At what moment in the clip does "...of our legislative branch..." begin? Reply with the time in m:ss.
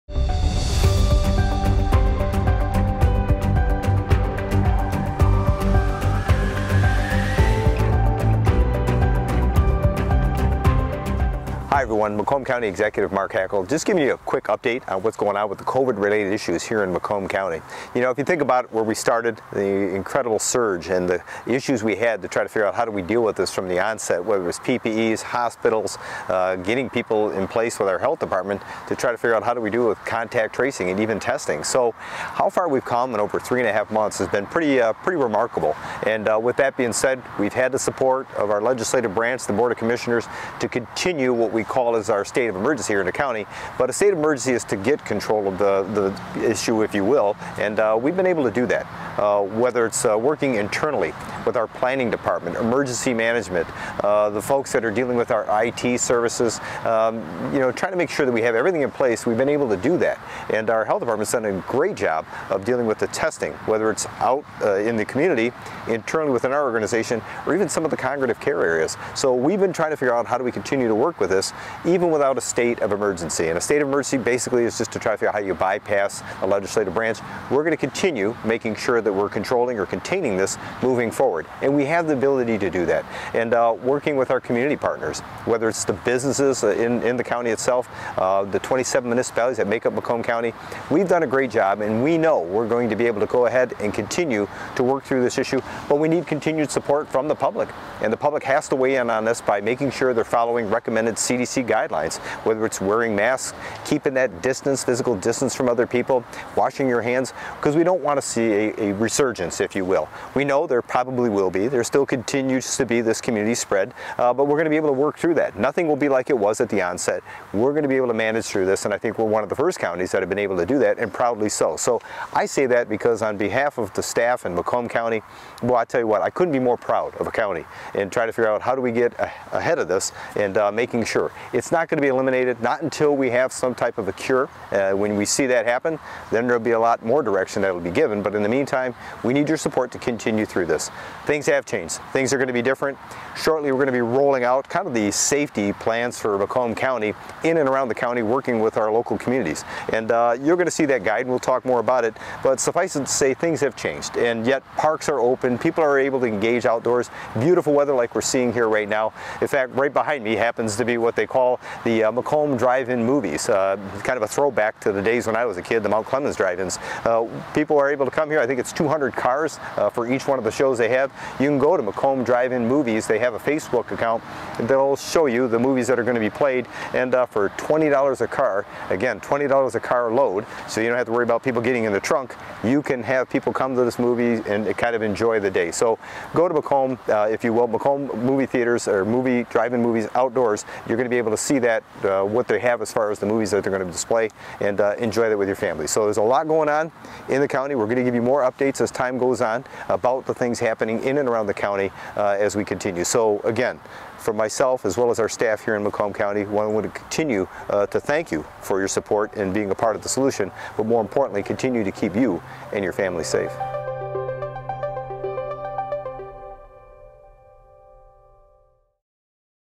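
0:38.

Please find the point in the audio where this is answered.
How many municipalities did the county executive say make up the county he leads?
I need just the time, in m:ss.
1:28.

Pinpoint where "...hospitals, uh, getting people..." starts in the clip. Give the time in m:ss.
0:25.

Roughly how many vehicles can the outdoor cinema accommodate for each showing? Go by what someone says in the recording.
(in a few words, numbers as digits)
200 cars.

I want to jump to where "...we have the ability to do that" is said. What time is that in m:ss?
1:21.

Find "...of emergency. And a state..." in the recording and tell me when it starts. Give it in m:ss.
1:12.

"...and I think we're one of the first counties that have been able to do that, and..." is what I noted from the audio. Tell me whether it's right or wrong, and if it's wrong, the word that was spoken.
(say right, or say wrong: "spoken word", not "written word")
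right.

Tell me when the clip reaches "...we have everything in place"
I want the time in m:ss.
0:58.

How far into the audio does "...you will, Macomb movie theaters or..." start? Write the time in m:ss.
3:07.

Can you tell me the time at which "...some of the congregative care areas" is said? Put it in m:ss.
1:07.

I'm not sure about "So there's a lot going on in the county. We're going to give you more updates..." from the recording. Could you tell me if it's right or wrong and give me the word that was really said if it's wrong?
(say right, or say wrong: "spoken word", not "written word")
right.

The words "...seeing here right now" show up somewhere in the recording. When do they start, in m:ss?
2:38.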